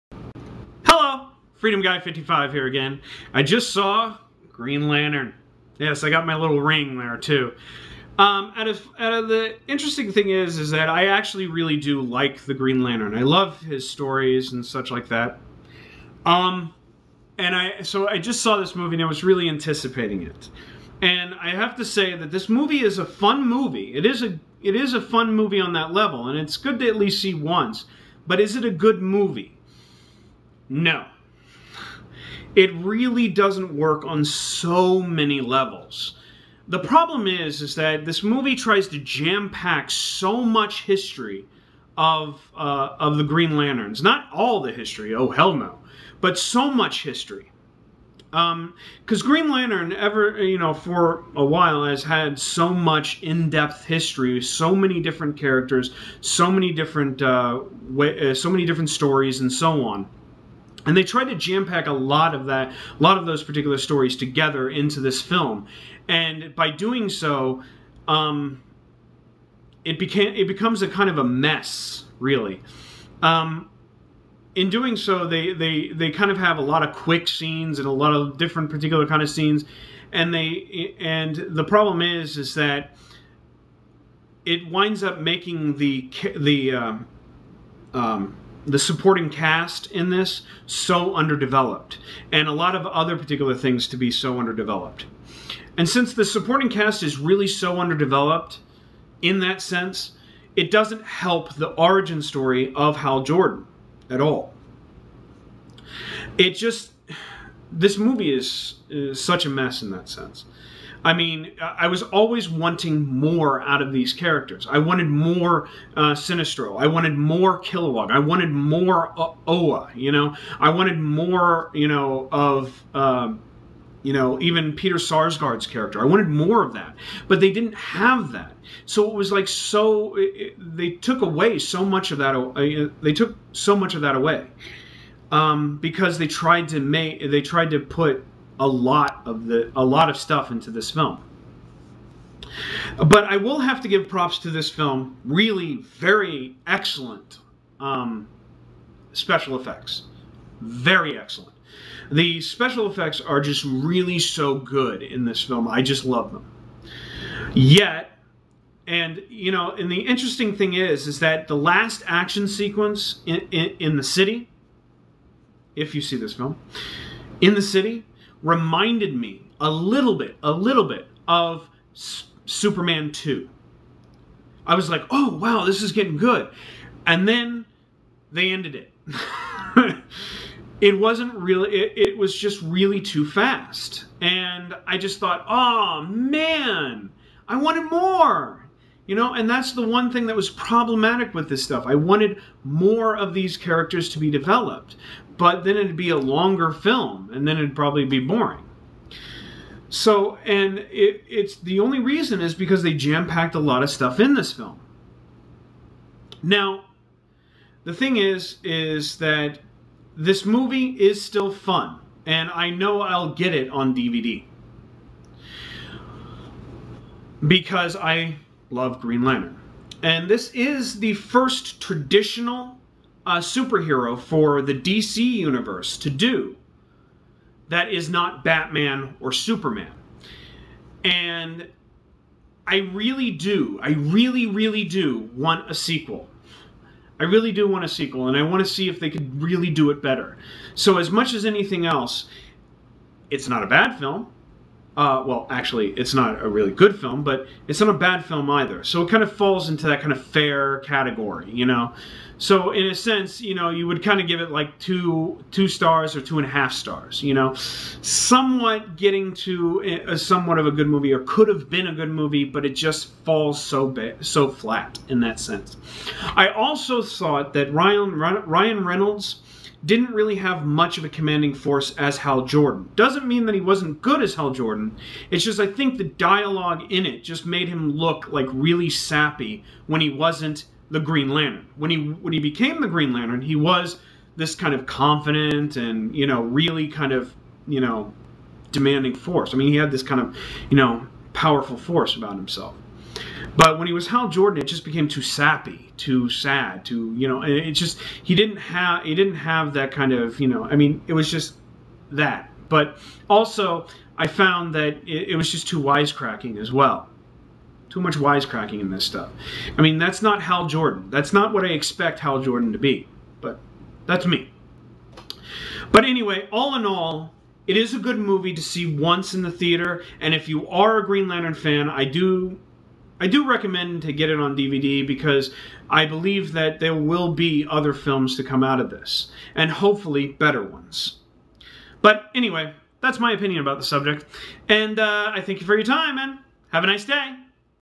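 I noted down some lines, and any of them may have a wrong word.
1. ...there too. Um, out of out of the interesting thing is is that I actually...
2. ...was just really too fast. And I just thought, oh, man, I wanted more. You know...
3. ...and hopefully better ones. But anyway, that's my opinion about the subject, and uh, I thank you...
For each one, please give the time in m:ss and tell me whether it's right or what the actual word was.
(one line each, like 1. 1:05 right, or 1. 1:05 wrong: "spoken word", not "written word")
1. 0:06 right
2. 3:02 right
3. 5:29 right.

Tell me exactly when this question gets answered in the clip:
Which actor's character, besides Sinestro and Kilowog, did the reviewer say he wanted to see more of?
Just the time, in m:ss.
2:04.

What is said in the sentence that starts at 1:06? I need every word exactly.
And by doing so, um, it became it becomes a kind of a mess, really.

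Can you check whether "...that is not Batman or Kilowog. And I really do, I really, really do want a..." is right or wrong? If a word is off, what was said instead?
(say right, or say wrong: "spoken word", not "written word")
wrong: "Superman", not "Kilowog".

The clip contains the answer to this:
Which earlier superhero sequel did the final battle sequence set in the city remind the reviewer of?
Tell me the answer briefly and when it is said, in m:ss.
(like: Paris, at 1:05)
Superman 2, at 2:52.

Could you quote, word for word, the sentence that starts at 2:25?
Really, very excellent um, special effects.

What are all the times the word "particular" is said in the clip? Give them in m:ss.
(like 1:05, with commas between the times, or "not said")
1:03, 1:18, 1:33.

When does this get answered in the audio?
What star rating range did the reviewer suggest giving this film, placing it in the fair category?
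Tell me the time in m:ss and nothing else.
4:14.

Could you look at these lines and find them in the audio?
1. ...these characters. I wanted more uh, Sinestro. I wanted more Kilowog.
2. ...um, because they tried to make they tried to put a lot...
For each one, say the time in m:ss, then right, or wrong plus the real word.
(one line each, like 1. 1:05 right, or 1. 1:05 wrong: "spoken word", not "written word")
1. 1:53 right
2. 2:15 right.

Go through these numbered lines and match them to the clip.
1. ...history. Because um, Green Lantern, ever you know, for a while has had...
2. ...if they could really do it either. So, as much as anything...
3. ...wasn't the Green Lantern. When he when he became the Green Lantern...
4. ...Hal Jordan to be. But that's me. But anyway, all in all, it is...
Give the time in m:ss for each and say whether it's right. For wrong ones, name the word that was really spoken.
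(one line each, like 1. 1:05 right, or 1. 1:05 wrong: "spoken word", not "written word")
1. 0:47 right
2. 3:58 wrong: "better", not "either"
3. 4:40 right
4. 5:12 right.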